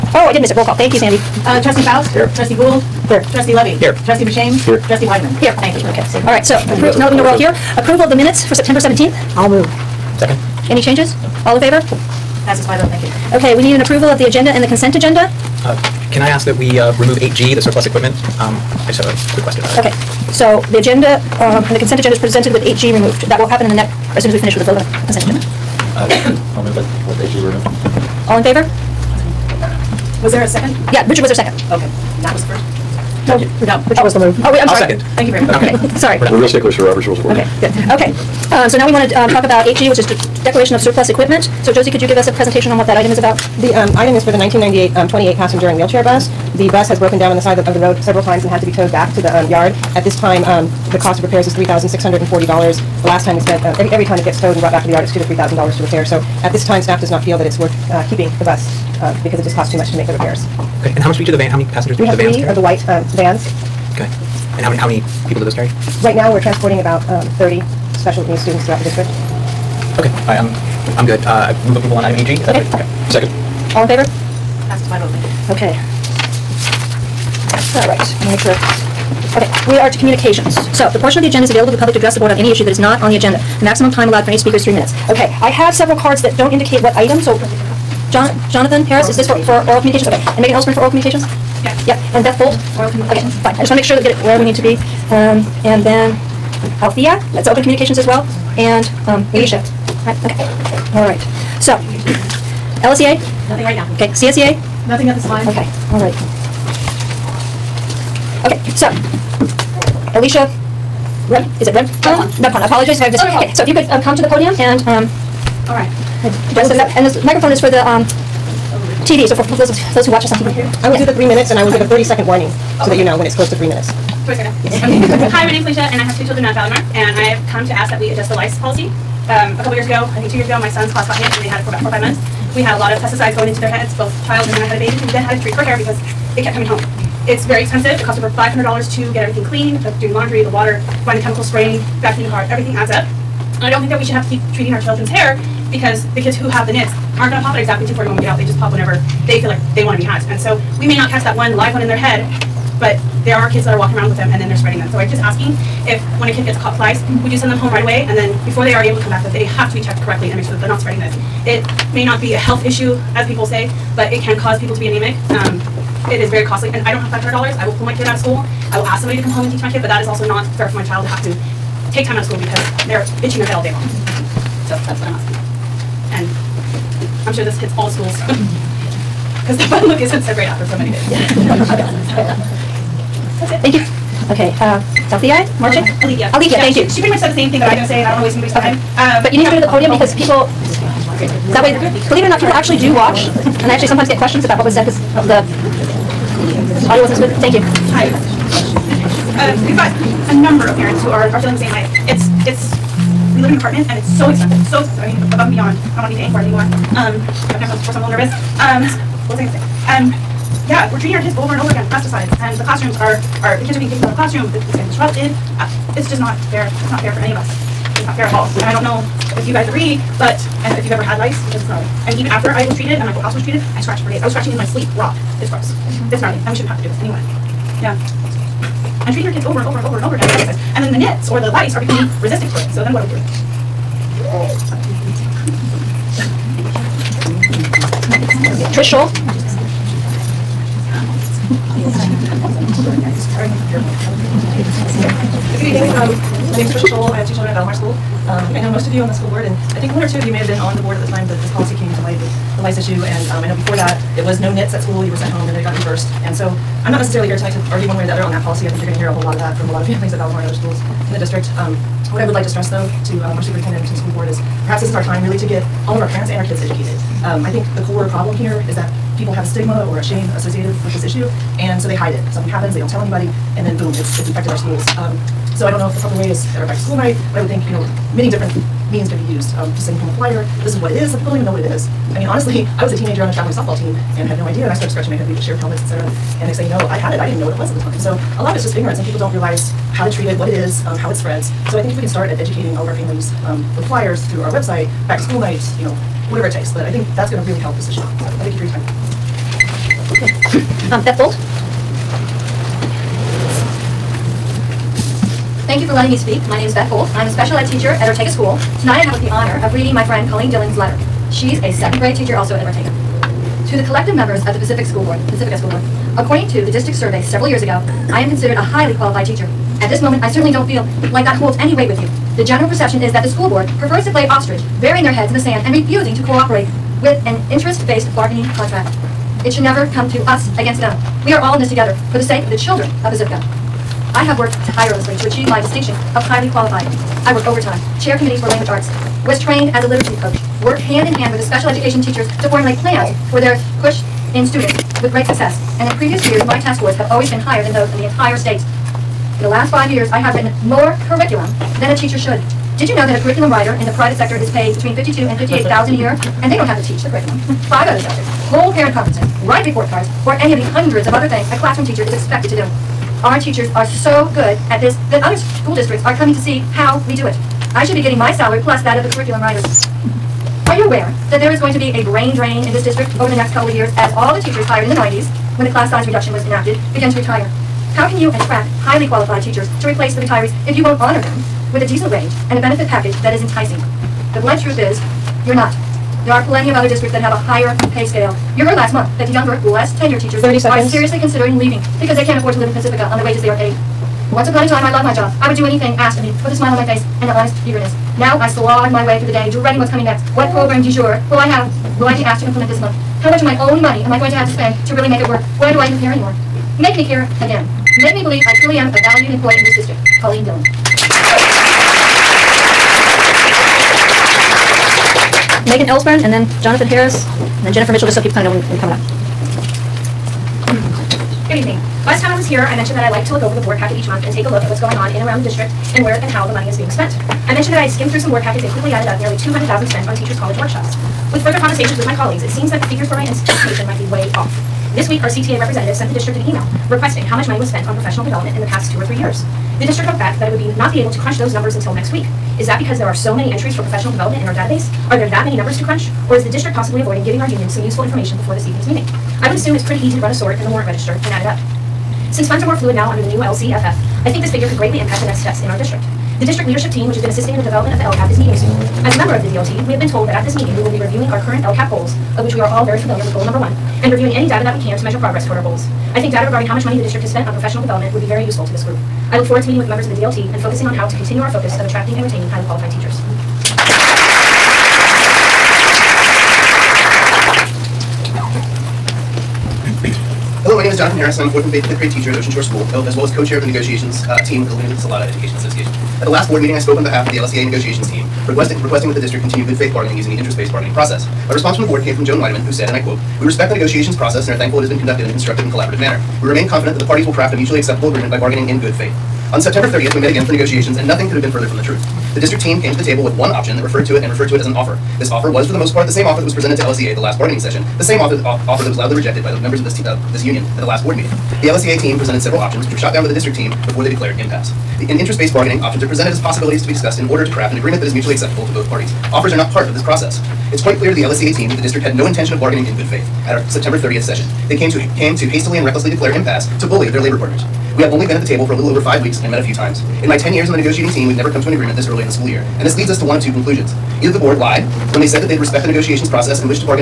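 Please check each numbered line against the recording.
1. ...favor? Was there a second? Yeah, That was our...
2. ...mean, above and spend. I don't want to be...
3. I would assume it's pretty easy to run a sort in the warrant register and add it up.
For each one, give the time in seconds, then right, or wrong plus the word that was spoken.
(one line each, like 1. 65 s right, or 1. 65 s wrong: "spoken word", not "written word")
1. 28 s wrong: "Richard", not "That"
2. 205 s wrong: "beyond", not "spend"
3. 449 s right.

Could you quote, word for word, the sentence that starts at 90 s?
Okay, and Megan Ellsburn for oral communications?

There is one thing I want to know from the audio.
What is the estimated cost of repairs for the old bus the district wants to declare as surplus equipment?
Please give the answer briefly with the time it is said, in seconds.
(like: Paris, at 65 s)
$3,640, at 51 s.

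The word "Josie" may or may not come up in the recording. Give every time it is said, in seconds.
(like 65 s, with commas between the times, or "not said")
41 s.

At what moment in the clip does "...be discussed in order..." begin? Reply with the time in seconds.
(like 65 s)
516 s.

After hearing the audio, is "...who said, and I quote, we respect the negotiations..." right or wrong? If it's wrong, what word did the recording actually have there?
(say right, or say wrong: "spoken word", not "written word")
right.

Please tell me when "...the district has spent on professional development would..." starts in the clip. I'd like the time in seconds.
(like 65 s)
466 s.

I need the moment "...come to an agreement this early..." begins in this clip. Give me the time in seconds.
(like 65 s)
531 s.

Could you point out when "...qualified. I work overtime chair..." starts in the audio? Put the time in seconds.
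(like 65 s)
336 s.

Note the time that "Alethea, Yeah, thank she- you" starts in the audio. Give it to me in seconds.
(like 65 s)
186 s.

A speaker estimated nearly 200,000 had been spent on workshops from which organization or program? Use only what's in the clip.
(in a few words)
Teachers' College.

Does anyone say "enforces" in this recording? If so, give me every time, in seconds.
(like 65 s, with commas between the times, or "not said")
not said.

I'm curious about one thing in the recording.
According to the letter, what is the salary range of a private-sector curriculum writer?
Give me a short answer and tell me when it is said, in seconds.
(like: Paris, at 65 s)
52,000 to 58,000, at 354 s.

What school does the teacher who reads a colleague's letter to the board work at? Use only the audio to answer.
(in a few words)
Ortega School.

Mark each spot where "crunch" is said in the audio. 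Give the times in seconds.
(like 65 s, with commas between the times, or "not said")
441 s, 445 s.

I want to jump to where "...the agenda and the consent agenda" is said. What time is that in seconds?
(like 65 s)
14 s.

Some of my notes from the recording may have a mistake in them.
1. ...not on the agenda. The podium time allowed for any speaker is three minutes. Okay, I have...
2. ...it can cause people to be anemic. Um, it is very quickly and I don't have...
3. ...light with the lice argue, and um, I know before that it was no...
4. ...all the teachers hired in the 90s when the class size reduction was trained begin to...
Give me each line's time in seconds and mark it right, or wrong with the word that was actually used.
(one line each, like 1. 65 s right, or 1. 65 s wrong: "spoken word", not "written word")
1. 82 s wrong: "maximum", not "podium"
2. 164 s wrong: "costly", not "quickly"
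3. 252 s wrong: "issue", not "argue"
4. 374 s wrong: "enacted", not "trained".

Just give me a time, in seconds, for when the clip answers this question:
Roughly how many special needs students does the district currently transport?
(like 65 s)
67 s.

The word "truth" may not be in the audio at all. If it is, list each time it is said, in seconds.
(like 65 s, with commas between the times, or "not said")
384 s, 501 s.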